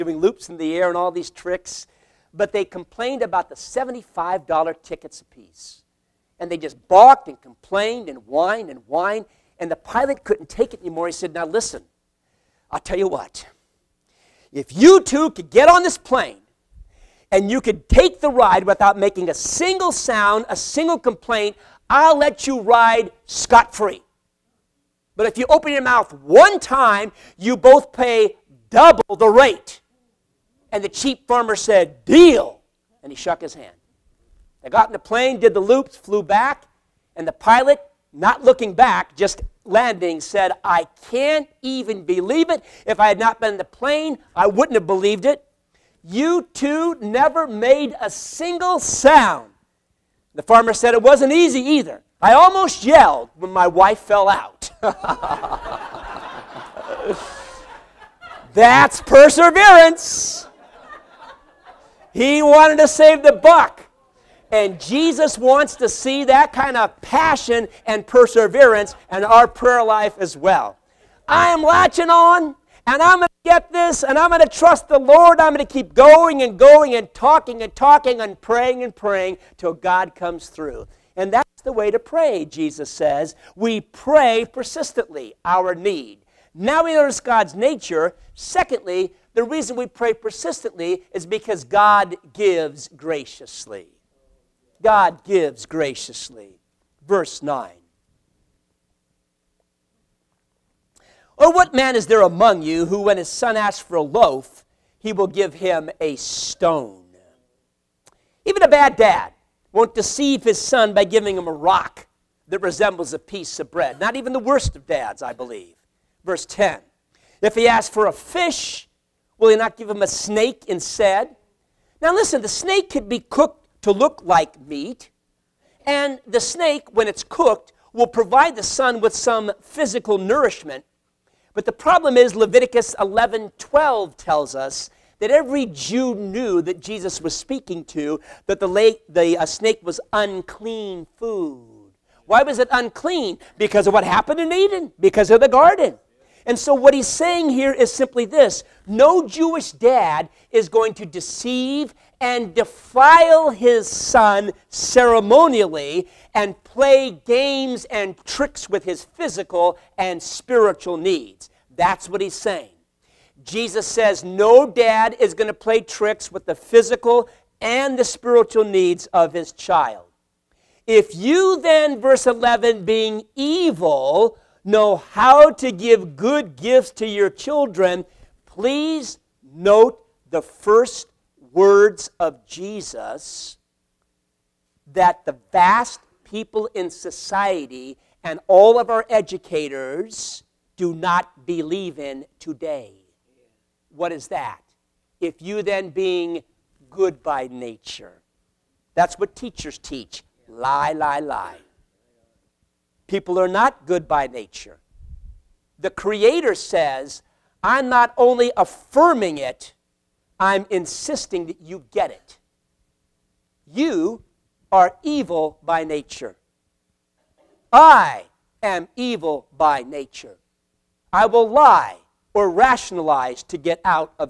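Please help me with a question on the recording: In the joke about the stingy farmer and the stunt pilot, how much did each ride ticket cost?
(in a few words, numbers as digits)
$75.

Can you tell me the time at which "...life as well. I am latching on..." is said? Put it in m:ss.
1:09.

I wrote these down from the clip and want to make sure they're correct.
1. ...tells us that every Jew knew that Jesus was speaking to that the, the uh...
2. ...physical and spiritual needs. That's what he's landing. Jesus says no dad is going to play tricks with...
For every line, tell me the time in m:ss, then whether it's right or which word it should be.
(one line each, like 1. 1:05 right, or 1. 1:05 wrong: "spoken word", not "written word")
1. 2:14 right
2. 2:39 wrong: "saying", not "landing".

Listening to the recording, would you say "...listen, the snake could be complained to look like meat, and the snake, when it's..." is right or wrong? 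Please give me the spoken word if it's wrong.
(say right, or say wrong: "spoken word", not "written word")
wrong: "cooked", not "complained".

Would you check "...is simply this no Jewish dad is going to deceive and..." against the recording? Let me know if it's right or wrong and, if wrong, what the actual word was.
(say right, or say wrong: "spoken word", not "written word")
right.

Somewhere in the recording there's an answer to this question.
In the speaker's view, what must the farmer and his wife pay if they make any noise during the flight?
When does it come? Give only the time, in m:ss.
0:28.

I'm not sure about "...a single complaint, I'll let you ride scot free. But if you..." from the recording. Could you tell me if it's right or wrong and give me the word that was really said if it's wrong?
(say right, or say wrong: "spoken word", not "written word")
right.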